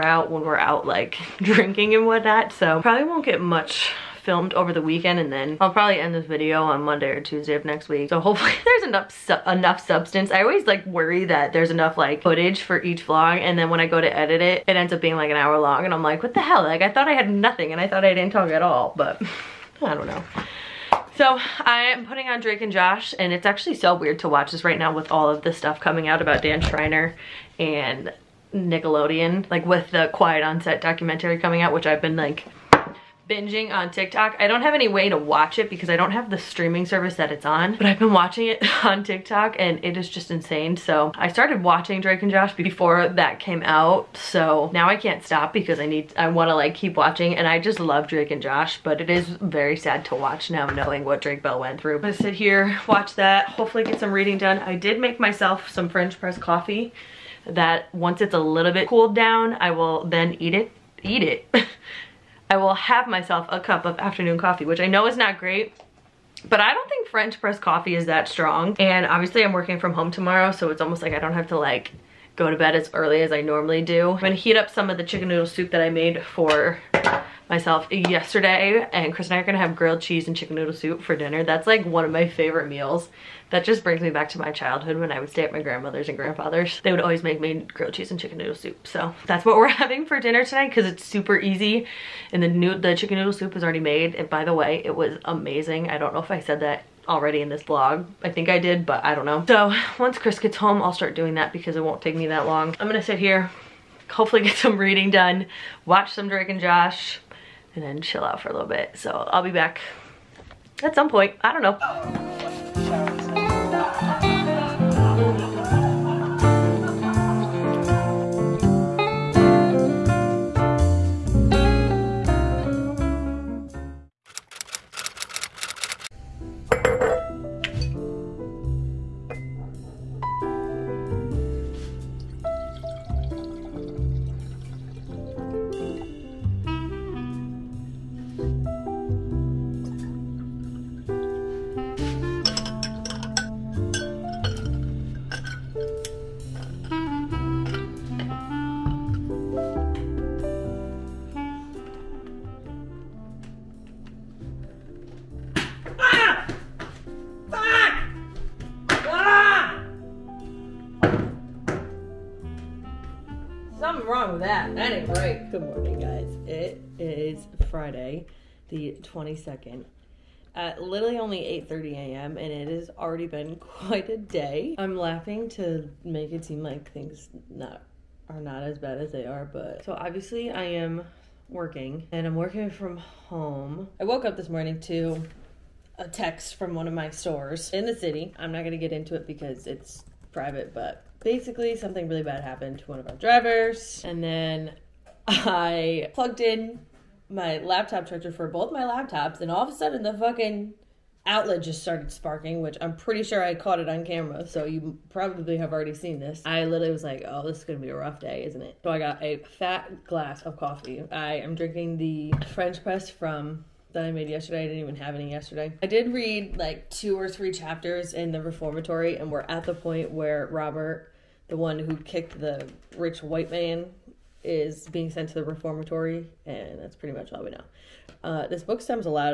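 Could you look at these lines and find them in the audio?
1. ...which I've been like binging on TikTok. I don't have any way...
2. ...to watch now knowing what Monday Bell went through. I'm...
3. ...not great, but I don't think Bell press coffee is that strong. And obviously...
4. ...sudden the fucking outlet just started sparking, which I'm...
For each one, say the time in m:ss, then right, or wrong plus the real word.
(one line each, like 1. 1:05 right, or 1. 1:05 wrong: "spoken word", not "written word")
1. 0:31 right
2. 0:50 wrong: "Drake", not "Monday"
3. 1:05 wrong: "French", not "Bell"
4. 3:19 right.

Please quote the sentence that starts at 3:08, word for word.
I'm not going to get into it because it's private, but basically something really bad happened to one of our drivers.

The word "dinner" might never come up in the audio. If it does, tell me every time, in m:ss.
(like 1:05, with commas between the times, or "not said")
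1:21, 1:30.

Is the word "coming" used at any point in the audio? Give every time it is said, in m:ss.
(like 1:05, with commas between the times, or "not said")
0:25, 0:31.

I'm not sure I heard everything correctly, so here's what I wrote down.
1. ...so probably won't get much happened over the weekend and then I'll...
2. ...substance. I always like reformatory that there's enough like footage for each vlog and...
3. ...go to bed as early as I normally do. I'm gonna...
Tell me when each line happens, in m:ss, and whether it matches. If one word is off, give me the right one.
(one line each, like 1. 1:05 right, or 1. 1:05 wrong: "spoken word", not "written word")
1. 0:02 wrong: "filmed", not "happened"
2. 0:09 wrong: "worry", not "reformatory"
3. 1:12 right.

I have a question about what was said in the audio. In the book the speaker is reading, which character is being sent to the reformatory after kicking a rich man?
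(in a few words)
Robert.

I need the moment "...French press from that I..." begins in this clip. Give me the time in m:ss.
3:32.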